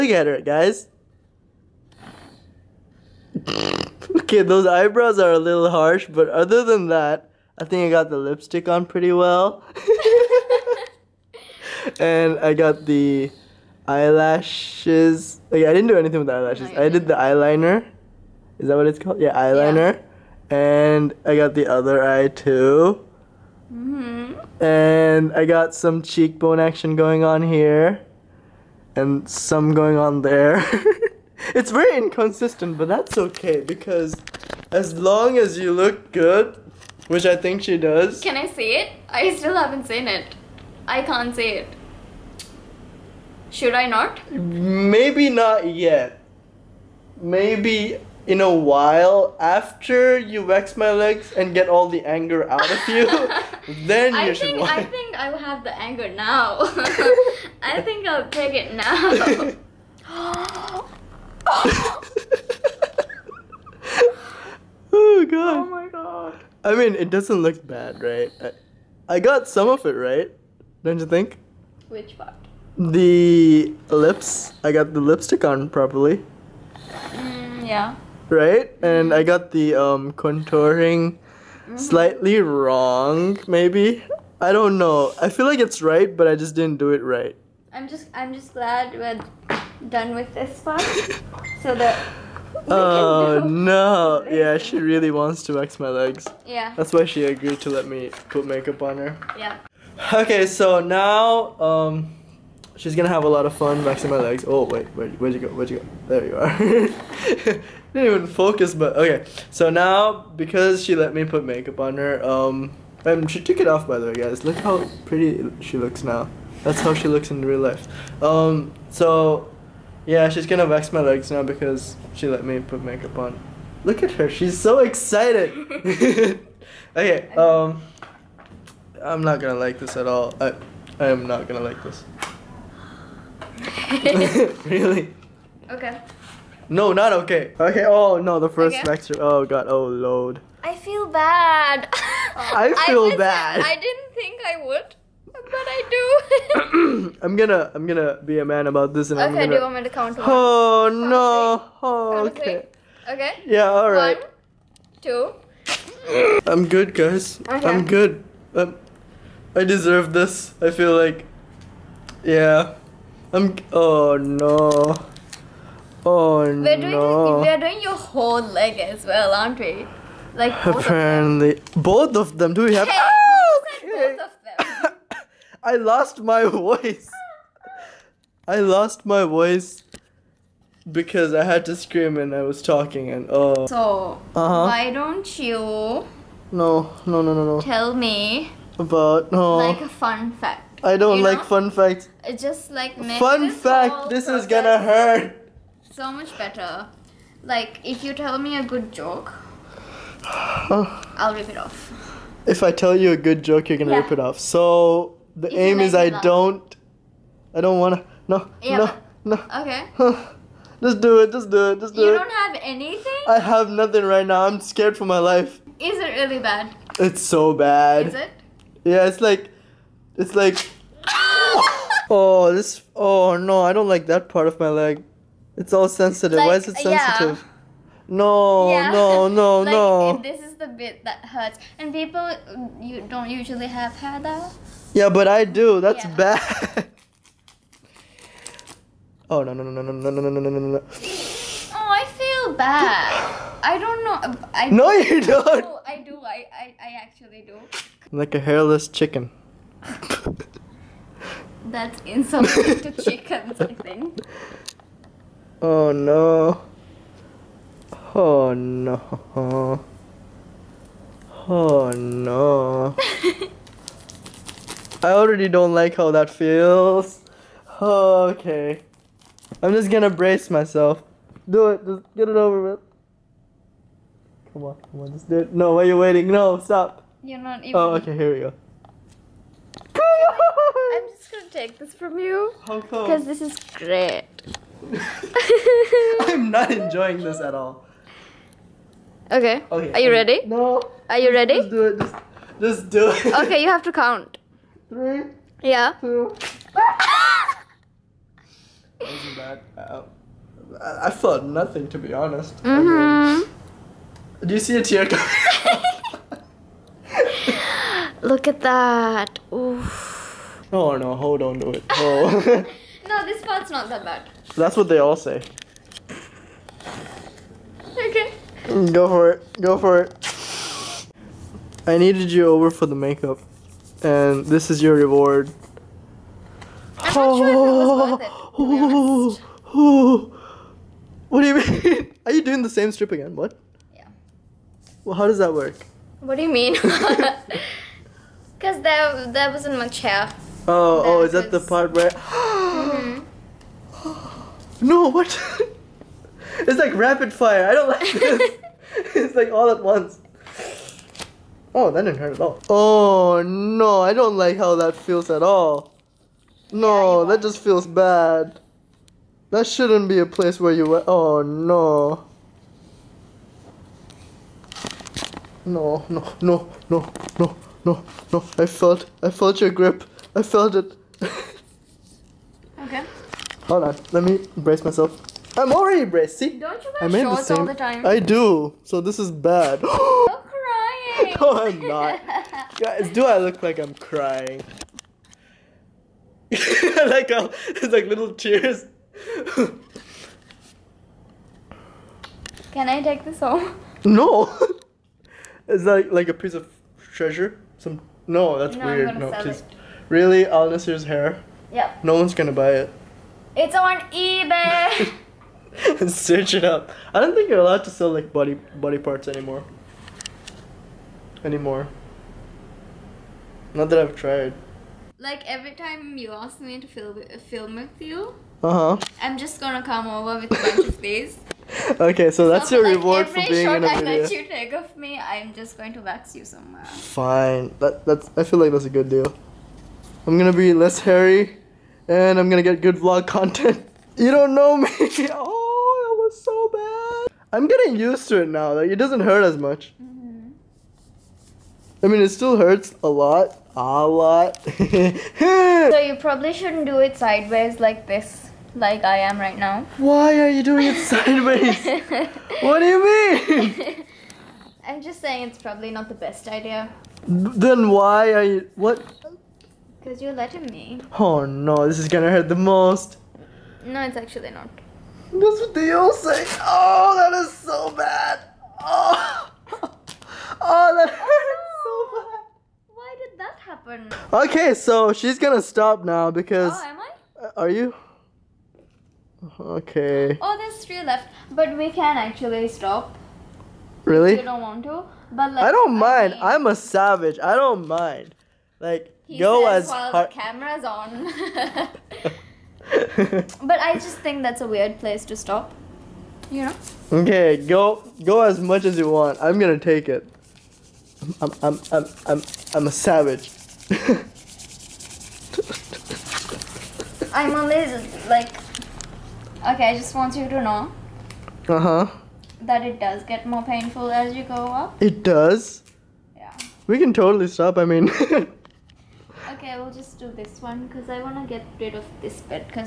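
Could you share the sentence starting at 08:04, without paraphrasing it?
You don't want to, but like.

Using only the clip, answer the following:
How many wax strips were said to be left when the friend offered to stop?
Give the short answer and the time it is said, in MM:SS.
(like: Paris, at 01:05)
3, at 08:00.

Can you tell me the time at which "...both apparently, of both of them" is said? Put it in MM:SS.
02:50.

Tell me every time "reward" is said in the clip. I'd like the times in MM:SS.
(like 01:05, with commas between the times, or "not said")
05:24, 07:02.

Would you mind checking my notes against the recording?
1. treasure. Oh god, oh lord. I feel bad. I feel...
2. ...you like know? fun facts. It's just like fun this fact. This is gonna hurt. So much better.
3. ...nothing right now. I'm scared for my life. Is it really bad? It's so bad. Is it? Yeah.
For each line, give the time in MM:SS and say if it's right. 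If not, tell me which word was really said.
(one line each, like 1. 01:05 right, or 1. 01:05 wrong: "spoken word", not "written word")
1. 02:18 wrong: "lecture", not "treasure"
2. 03:11 right
3. 03:33 right.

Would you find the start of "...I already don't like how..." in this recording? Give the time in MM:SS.
04:25.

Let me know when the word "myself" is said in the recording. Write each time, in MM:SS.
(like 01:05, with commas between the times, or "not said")
04:30, 06:14.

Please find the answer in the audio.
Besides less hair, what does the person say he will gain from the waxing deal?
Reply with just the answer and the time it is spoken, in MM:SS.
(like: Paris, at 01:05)
vlog content, at 07:12.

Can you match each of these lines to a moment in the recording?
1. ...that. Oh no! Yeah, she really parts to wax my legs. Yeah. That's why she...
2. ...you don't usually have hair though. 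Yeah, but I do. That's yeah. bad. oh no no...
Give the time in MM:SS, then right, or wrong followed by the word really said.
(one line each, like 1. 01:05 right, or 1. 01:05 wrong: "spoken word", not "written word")
1. 01:31 wrong: "wants", not "parts"
2. 03:52 right.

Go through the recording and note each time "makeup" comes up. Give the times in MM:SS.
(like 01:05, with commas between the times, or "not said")
01:38, 01:51, 02:02, 05:22.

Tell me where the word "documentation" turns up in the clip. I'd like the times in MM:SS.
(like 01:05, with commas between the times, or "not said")
not said.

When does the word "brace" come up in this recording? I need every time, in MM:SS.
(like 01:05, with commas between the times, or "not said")
04:30, 06:14.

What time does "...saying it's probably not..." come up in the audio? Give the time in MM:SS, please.
07:35.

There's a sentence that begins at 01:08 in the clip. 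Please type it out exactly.
I, I got some of it right, don't you think?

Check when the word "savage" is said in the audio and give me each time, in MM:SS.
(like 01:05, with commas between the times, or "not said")
08:06, 08:22.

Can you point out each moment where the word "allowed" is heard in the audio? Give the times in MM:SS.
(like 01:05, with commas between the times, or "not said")
06:47.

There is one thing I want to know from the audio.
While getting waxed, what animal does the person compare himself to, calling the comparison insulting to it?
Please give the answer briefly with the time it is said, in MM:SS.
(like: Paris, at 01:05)
hairless chicken, at 04:08.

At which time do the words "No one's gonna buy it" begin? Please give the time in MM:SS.
06:42.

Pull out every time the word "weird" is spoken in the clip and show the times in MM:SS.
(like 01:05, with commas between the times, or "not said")
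06:38, 08:14.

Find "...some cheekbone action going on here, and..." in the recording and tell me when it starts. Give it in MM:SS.
00:25.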